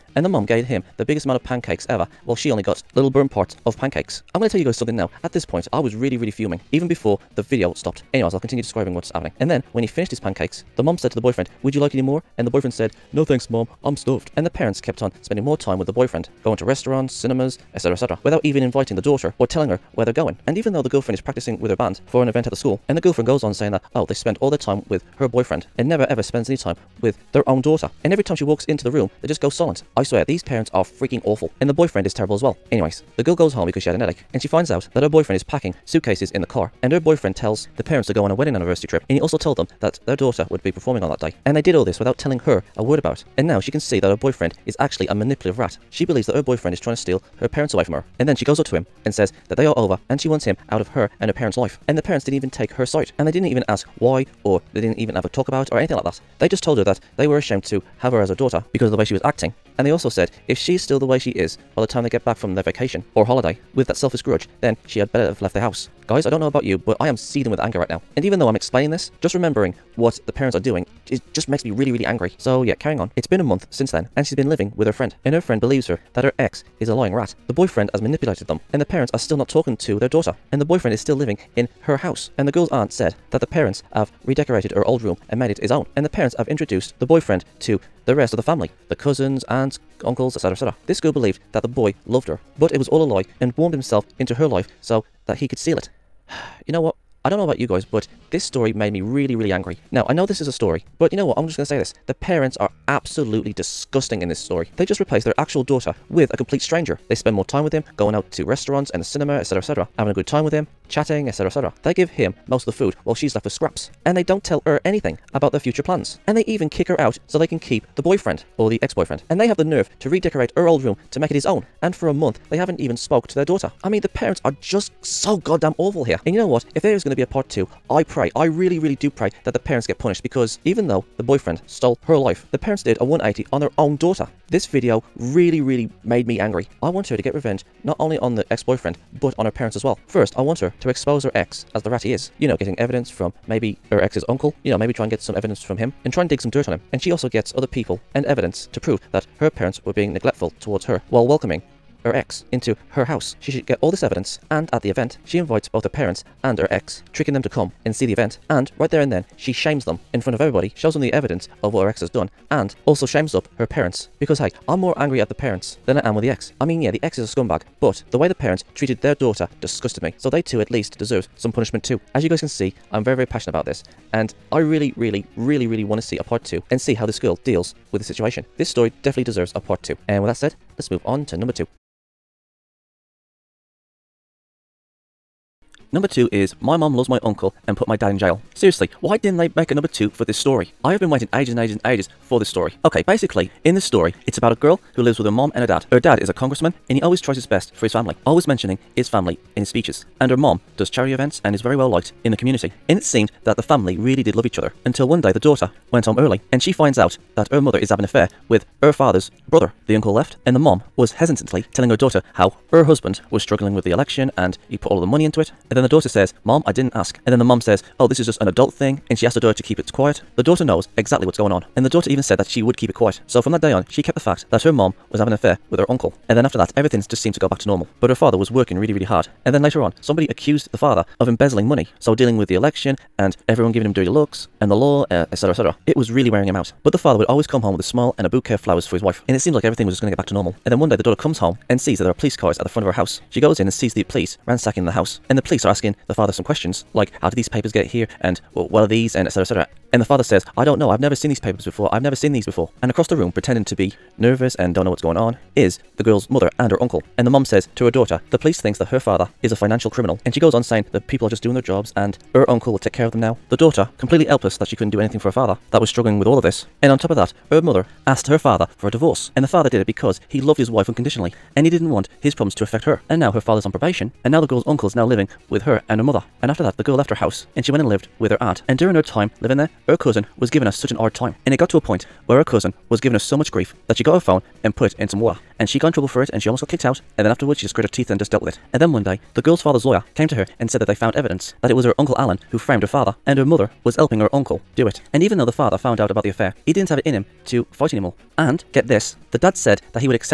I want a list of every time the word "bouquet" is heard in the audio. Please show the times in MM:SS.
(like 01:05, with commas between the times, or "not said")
03:58.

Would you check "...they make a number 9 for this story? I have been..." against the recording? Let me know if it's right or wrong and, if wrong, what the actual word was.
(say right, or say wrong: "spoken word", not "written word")
wrong: "2", not "9".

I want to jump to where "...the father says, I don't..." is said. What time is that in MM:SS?
04:10.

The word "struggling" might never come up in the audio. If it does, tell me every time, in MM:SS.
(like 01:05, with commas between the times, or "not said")
03:33, 04:25.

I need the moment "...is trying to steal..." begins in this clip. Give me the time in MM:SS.
00:46.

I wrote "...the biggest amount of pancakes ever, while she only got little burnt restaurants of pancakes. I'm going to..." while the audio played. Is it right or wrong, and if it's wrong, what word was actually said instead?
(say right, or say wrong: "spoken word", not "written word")
wrong: "parts", not "restaurants".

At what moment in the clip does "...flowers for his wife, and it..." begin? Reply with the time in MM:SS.
03:58.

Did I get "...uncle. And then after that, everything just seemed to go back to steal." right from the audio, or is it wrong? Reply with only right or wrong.
wrong.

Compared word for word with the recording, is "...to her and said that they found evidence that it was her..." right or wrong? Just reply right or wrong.
right.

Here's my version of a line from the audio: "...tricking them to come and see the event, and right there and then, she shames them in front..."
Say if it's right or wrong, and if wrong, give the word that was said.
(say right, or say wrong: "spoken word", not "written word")
right.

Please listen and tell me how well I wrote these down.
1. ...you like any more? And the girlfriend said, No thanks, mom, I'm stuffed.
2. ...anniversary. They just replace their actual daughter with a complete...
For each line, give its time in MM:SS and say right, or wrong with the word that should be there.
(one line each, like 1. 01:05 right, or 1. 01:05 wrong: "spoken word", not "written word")
1. 00:11 wrong: "boyfriend", not "girlfriend"
2. 01:44 wrong: "story", not "anniversary".